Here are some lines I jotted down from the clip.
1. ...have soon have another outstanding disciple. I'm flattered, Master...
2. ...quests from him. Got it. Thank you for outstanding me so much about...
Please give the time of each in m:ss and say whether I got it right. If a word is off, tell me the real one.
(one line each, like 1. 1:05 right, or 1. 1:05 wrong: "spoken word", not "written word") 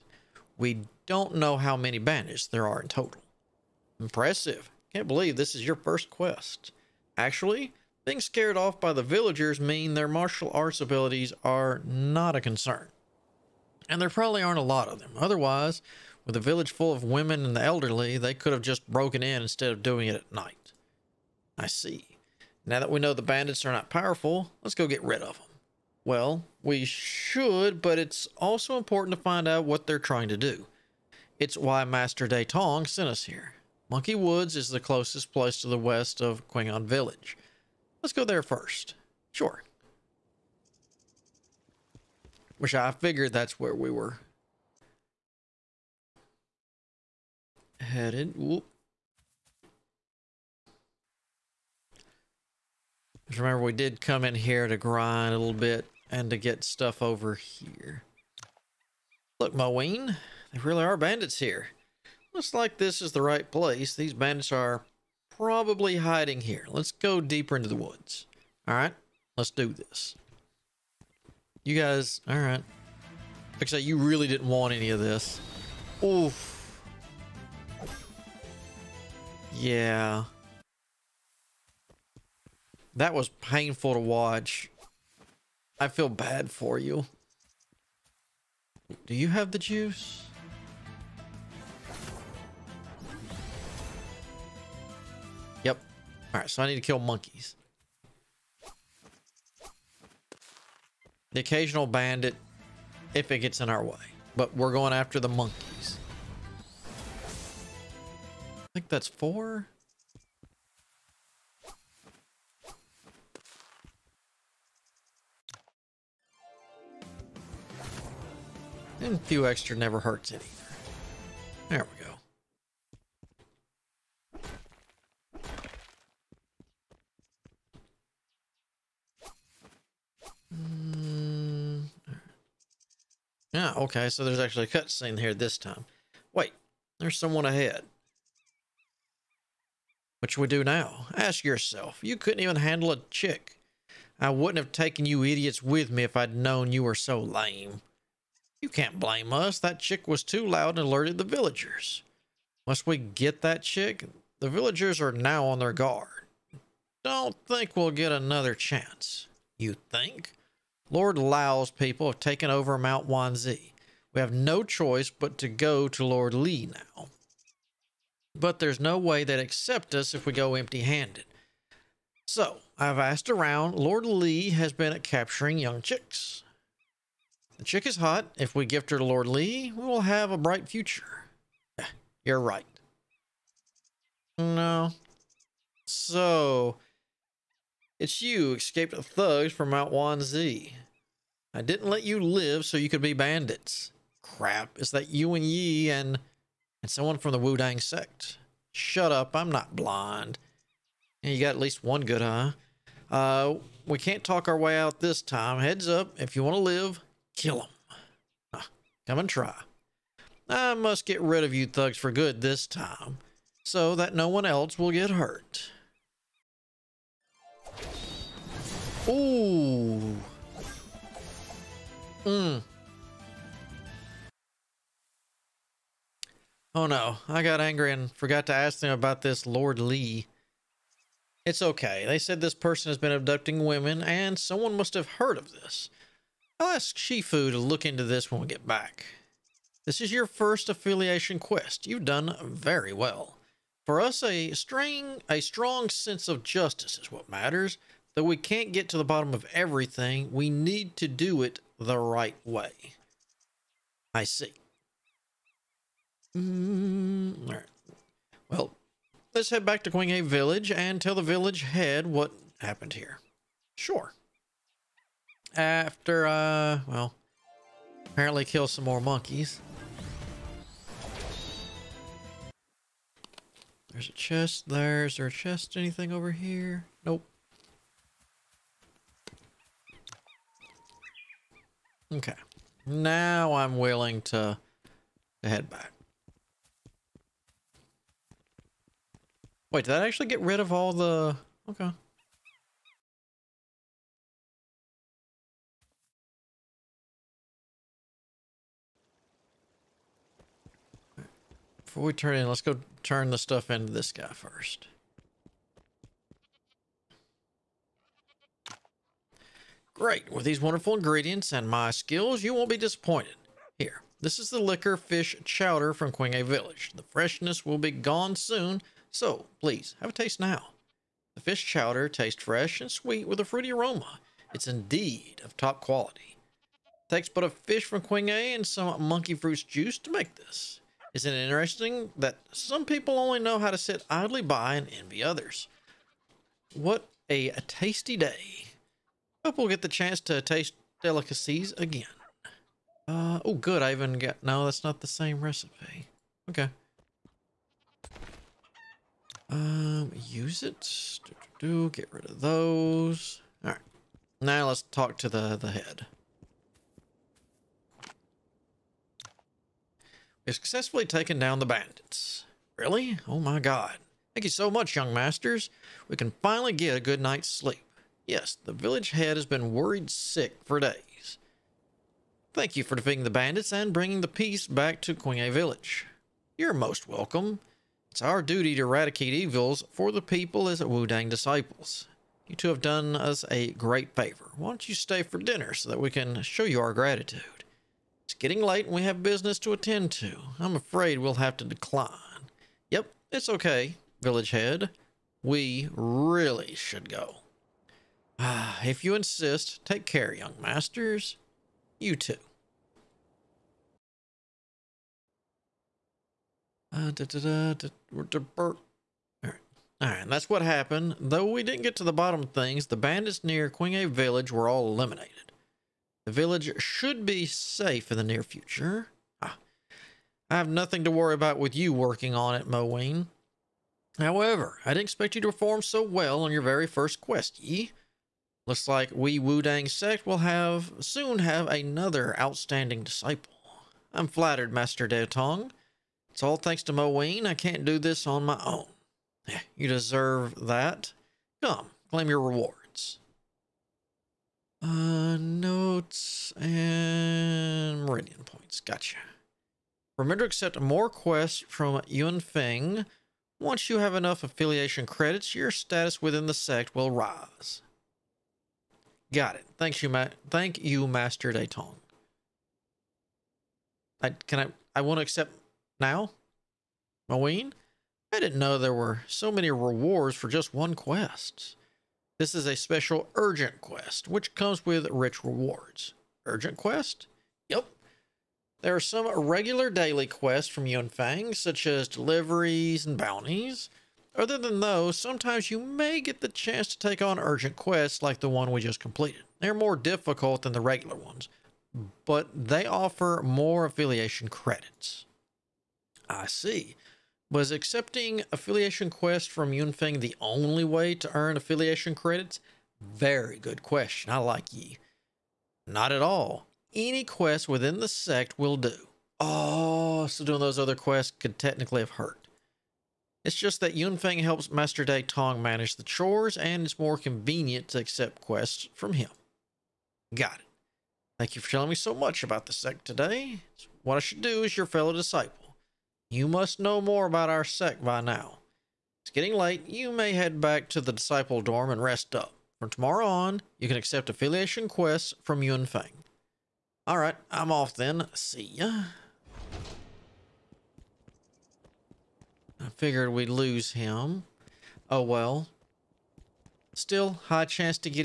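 1. 7:10 right
2. 8:38 wrong: "telling", not "outstanding".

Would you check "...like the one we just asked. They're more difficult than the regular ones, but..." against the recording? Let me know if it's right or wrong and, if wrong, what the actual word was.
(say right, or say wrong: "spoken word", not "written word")
wrong: "completed", not "asked".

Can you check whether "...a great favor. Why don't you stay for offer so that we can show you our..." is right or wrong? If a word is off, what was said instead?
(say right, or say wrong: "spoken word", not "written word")
wrong: "dinner", not "offer".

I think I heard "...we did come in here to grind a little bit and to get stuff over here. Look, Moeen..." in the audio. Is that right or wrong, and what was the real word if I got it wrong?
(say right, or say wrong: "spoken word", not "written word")
right.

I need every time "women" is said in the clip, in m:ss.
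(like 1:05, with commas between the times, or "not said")
0:17, 3:53.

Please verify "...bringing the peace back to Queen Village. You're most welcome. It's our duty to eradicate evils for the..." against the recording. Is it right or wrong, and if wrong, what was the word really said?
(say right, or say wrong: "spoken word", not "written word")
right.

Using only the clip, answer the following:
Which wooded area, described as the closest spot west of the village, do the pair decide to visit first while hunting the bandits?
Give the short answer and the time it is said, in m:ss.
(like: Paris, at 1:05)
Monkey Woods, at 0:33.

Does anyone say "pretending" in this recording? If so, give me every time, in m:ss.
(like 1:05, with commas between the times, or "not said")
not said.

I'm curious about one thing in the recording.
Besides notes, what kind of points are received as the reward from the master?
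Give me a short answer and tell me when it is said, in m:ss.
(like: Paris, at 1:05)
Meridian points, at 7:28.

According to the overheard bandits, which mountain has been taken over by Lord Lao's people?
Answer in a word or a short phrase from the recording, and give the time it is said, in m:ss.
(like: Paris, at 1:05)
Mount Wanzi, at 2:42.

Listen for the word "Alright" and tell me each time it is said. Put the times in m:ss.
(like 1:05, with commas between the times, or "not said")
1:36, 8:57.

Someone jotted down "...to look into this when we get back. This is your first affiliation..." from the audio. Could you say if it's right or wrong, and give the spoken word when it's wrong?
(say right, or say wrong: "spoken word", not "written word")
right.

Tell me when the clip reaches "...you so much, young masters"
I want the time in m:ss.
6:04.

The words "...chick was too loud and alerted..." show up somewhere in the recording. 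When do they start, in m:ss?
2:29.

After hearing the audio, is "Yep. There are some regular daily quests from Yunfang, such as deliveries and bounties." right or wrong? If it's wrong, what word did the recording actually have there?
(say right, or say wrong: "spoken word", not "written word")
right.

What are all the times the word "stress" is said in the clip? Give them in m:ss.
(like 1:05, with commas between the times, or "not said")
not said.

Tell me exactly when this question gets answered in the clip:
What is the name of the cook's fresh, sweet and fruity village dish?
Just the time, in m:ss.
5:14.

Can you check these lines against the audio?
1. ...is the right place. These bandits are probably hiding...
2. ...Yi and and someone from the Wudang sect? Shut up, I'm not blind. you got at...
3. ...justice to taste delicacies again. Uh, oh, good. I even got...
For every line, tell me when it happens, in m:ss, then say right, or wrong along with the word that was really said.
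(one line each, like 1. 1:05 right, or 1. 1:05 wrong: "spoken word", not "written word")
1. 1:03 right
2. 3:15 right
3. 5:39 wrong: "chance", not "justice".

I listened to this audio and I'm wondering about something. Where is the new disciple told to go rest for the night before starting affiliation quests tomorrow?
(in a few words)
disciple dorm.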